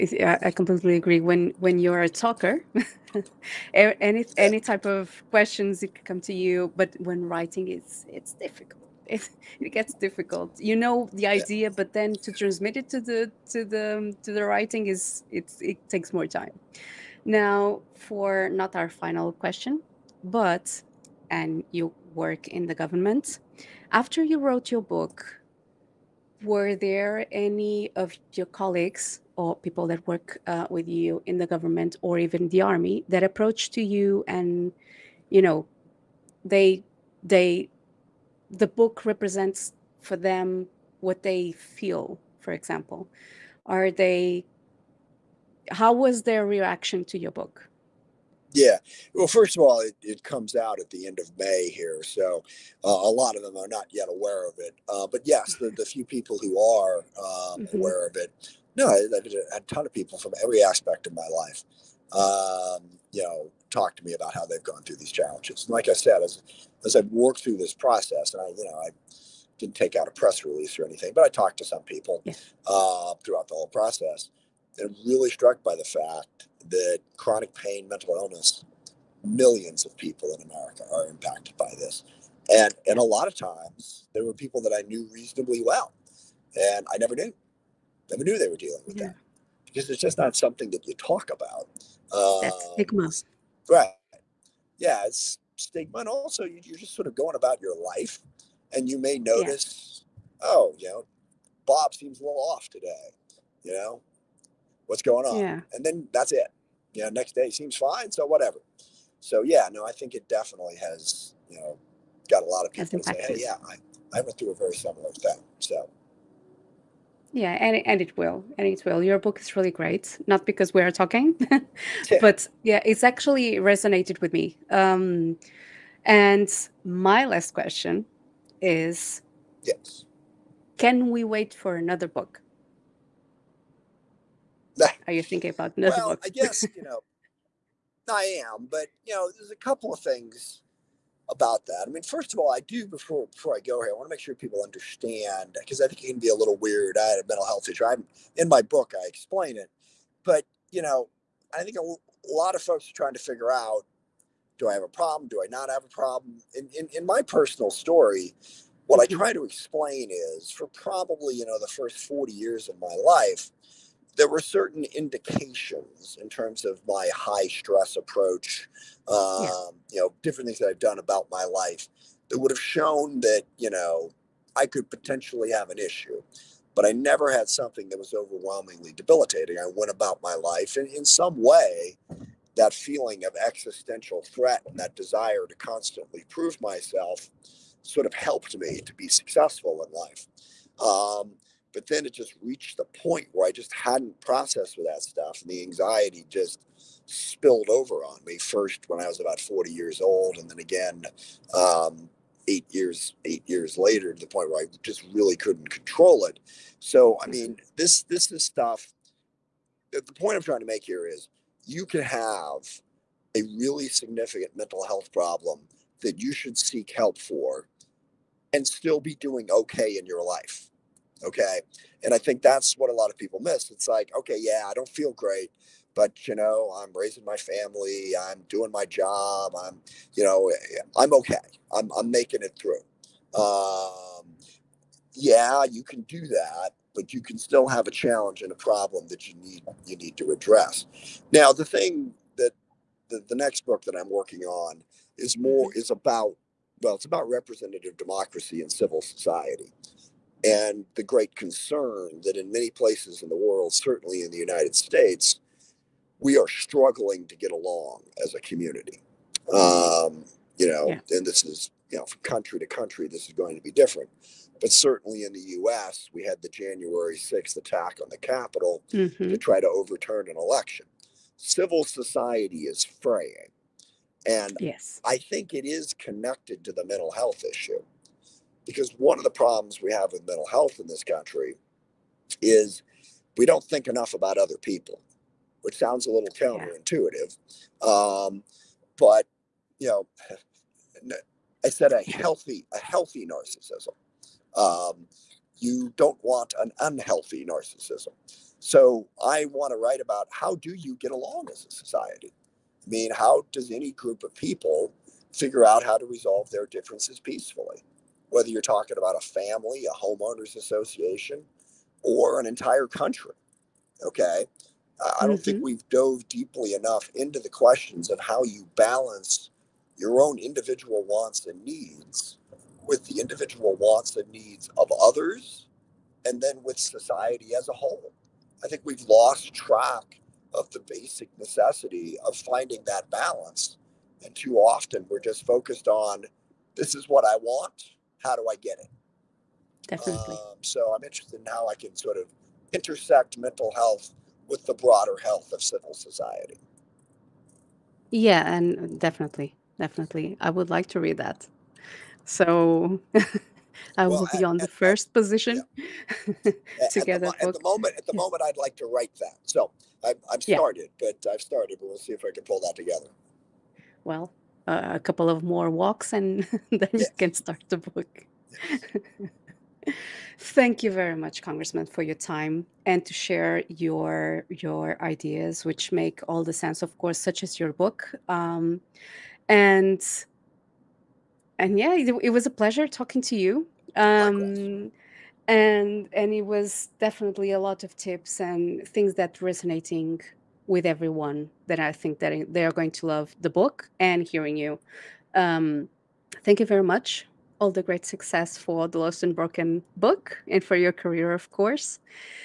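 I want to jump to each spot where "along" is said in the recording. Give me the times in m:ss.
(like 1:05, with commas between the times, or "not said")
4:17, 5:01.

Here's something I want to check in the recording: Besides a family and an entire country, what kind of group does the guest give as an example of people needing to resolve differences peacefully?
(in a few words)
A homeowners association.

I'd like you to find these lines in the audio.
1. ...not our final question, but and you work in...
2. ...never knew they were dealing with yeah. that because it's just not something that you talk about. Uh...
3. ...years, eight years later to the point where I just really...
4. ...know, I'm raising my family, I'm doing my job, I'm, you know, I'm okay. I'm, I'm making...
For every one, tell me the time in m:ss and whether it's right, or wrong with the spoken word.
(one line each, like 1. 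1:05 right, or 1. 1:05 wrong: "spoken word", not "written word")
1. 0:18 right
2. 1:28 right
3. 3:22 right
4. 3:46 right.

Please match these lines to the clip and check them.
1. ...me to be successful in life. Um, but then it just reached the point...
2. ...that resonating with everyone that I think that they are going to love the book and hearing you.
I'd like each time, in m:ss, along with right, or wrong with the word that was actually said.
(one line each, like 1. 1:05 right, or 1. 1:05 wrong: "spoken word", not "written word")
1. 3:08 right
2. 6:29 right.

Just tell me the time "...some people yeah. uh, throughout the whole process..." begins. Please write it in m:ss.
1:11.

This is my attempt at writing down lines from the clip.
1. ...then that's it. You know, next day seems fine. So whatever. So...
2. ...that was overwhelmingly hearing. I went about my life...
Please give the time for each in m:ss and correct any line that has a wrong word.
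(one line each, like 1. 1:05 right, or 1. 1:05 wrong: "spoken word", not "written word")
1. 1:45 right
2. 2:57 wrong: "debilitating", not "hearing".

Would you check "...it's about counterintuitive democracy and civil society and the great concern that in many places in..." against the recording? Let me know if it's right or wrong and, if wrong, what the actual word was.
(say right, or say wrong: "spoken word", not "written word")
wrong: "representative", not "counterintuitive".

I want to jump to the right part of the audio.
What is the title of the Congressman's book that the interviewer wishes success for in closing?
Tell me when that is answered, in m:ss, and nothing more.
6:38.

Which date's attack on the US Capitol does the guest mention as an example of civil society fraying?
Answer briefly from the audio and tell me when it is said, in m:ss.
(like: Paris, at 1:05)
January 6th, at 4:26.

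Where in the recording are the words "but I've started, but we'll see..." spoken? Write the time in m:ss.
6:01.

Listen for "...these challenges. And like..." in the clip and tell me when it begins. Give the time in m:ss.
1:04.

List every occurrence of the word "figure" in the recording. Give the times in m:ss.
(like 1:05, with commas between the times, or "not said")
2:33, 5:05.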